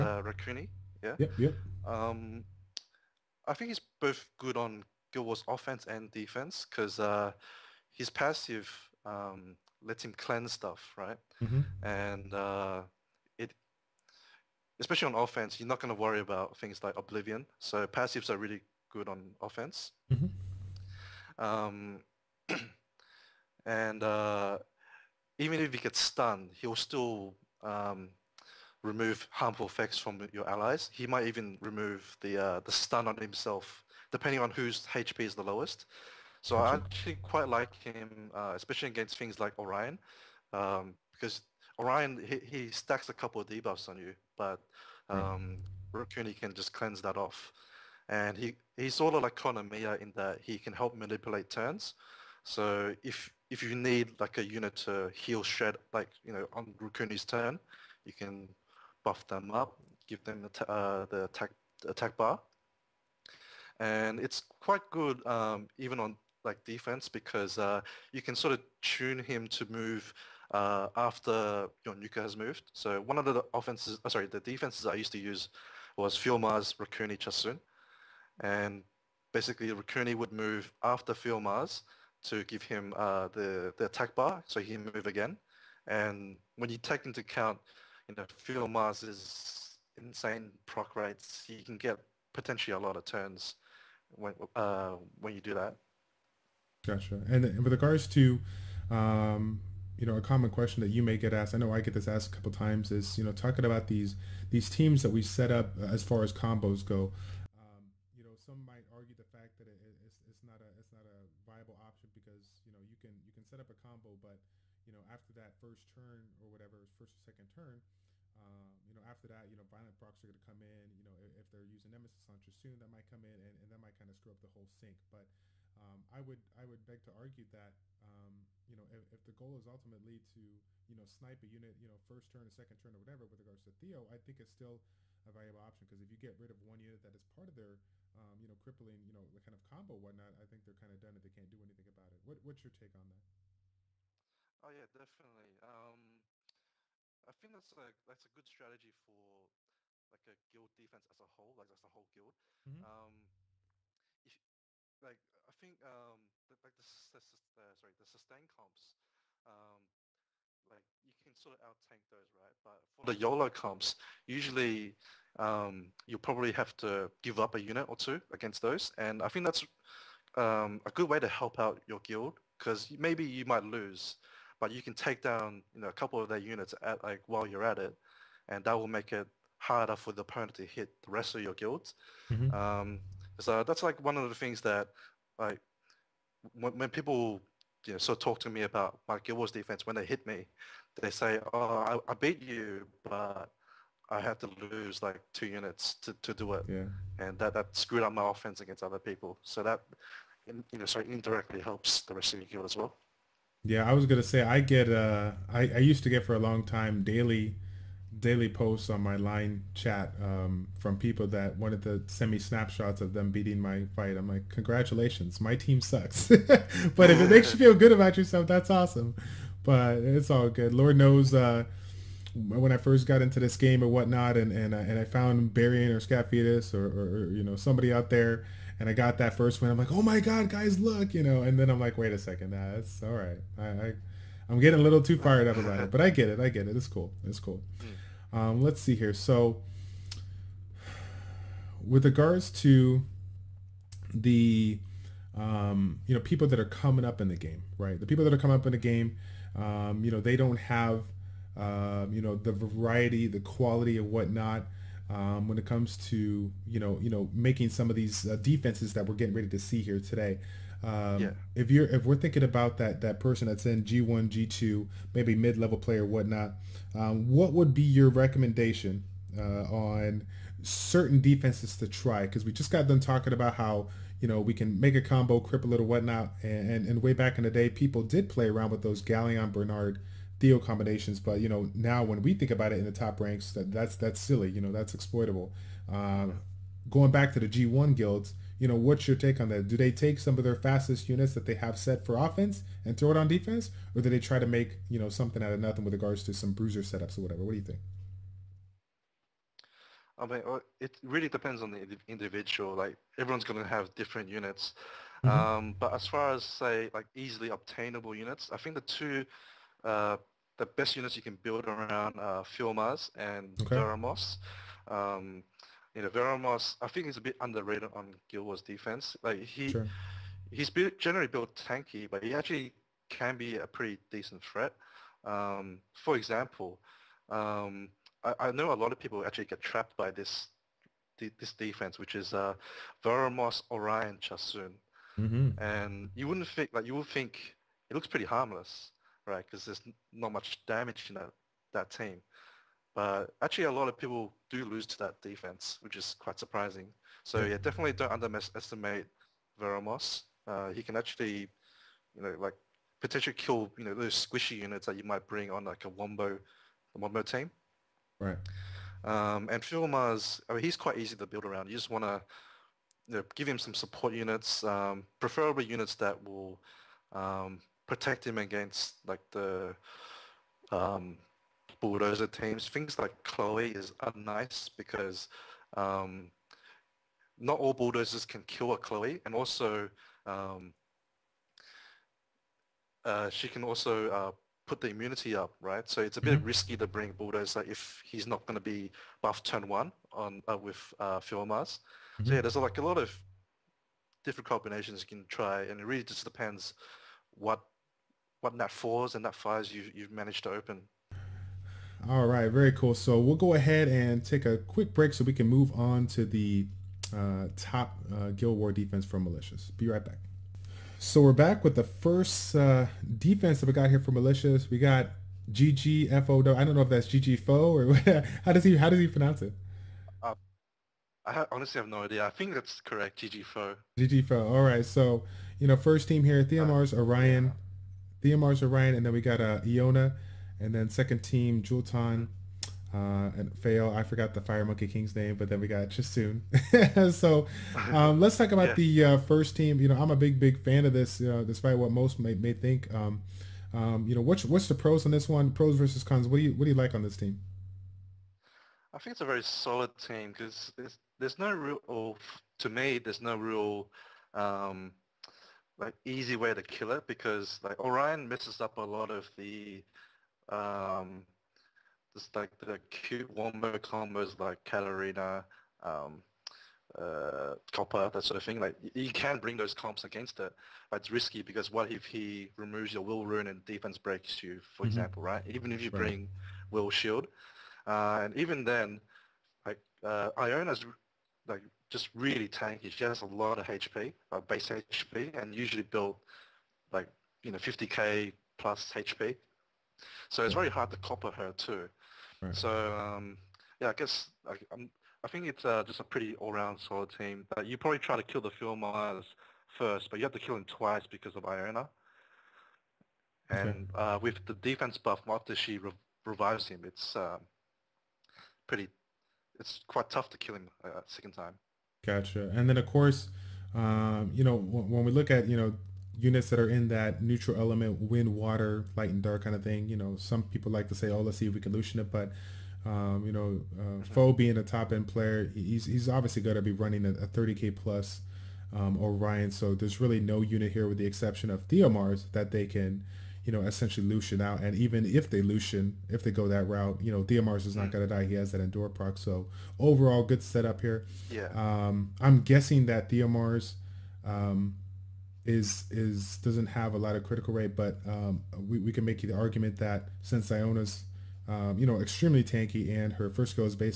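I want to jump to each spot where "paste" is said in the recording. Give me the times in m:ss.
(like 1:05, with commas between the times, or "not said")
not said.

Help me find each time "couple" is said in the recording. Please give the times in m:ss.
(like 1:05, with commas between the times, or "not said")
0:43, 1:42, 2:55.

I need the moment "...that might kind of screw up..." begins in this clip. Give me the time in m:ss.
2:03.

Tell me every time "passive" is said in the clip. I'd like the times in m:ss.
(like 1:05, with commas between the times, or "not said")
0:08, 0:17.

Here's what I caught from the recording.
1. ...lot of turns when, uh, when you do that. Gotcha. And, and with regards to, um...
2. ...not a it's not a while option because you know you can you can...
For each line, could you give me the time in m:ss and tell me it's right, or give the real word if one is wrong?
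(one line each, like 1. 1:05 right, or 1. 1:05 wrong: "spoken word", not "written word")
1. 1:32 right
2. 1:50 wrong: "viable", not "while".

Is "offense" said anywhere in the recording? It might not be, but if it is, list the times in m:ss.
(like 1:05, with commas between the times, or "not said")
0:05, 0:15, 0:19, 1:13, 3:18, 4:52.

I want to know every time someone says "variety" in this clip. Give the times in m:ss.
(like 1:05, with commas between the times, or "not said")
4:12.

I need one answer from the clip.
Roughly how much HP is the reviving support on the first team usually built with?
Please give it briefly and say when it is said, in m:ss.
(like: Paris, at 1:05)
50k plus, at 8:07.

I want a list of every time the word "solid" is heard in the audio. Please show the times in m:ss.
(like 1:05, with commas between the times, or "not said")
7:29, 8:16.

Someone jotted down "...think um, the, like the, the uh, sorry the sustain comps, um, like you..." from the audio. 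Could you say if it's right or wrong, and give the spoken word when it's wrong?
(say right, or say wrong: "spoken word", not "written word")
right.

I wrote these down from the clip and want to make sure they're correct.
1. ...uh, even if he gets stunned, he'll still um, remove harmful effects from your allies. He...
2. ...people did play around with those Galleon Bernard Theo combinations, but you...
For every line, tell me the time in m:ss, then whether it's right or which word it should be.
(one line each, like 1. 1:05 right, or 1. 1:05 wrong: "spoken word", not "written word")
1. 0:24 right
2. 4:37 right.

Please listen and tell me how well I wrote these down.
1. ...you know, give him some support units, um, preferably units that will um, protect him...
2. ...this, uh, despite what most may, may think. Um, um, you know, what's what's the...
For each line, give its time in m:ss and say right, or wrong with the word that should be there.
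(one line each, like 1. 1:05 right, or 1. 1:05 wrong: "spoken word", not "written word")
1. 6:03 right
2. 7:20 right.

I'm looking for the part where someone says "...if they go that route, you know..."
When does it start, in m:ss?
8:56.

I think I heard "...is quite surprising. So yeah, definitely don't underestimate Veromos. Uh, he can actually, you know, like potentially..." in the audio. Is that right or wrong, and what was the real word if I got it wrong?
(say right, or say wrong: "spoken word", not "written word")
right.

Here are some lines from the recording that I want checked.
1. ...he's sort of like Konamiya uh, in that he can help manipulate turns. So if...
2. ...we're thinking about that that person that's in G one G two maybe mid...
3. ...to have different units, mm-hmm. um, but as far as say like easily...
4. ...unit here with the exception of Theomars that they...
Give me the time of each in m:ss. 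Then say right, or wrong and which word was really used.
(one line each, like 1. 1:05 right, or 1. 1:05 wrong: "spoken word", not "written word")
1. 0:48 right
2. 4:22 right
3. 5:03 right
4. 8:50 right.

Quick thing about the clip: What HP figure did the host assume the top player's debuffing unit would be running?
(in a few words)
30K plus.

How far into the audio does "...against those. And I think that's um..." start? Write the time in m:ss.
2:48.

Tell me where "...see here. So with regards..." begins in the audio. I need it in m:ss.
3:58.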